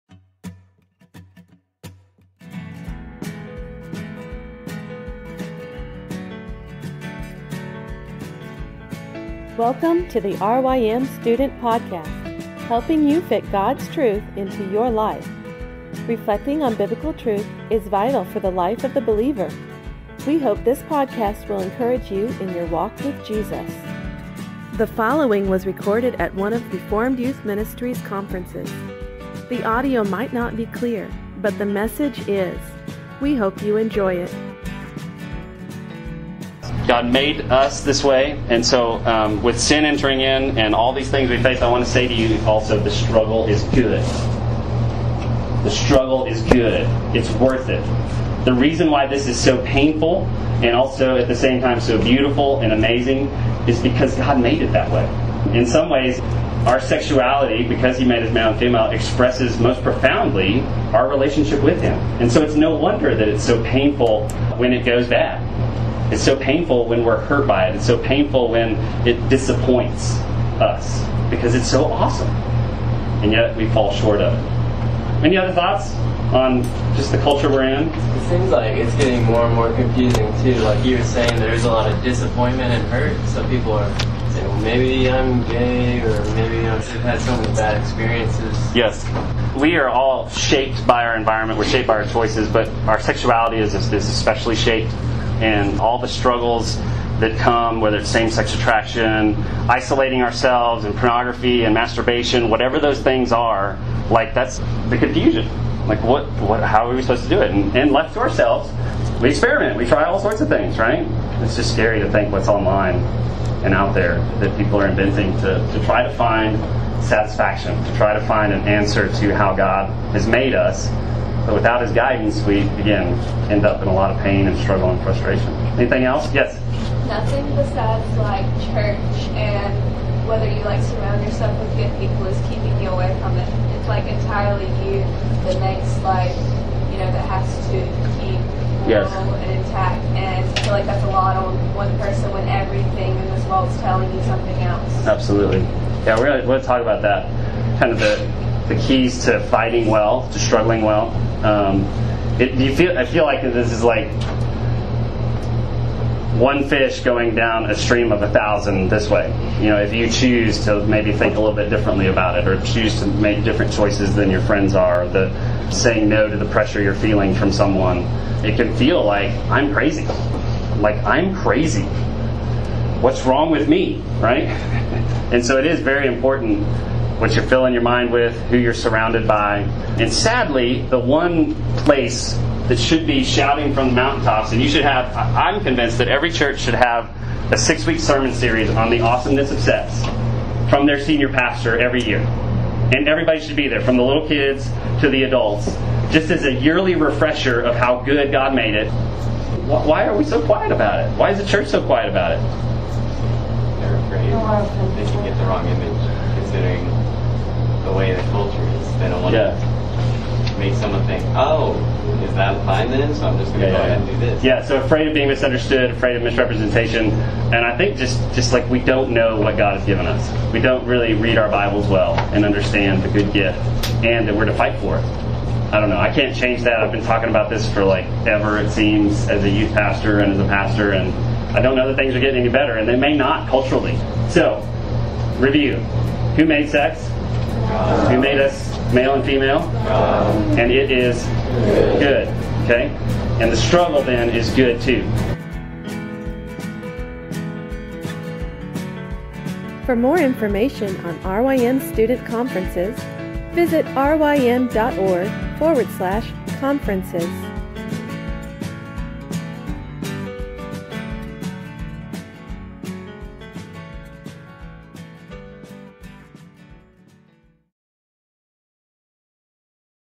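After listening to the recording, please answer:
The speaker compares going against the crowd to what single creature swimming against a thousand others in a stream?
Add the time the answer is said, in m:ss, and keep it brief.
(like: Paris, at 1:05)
fish, at 2:36.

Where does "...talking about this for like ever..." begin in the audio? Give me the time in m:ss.
3:47.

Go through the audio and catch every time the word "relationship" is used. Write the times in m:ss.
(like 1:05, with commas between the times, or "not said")
1:01.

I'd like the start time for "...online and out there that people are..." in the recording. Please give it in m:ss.
1:52.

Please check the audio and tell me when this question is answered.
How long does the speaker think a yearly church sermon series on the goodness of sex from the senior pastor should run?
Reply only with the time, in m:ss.
3:07.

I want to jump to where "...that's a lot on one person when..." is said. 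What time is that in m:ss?
2:20.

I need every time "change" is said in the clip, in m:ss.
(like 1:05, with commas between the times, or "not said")
3:46.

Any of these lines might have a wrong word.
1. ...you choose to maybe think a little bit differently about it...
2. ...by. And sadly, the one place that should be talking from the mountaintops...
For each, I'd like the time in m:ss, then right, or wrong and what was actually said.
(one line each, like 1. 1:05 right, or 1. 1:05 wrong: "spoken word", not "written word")
1. 2:39 right
2. 2:59 wrong: "shouting", not "talking".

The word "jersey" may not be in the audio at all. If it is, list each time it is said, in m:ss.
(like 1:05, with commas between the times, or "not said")
not said.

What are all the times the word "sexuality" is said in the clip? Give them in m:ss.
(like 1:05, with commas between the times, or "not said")
0:56, 1:32.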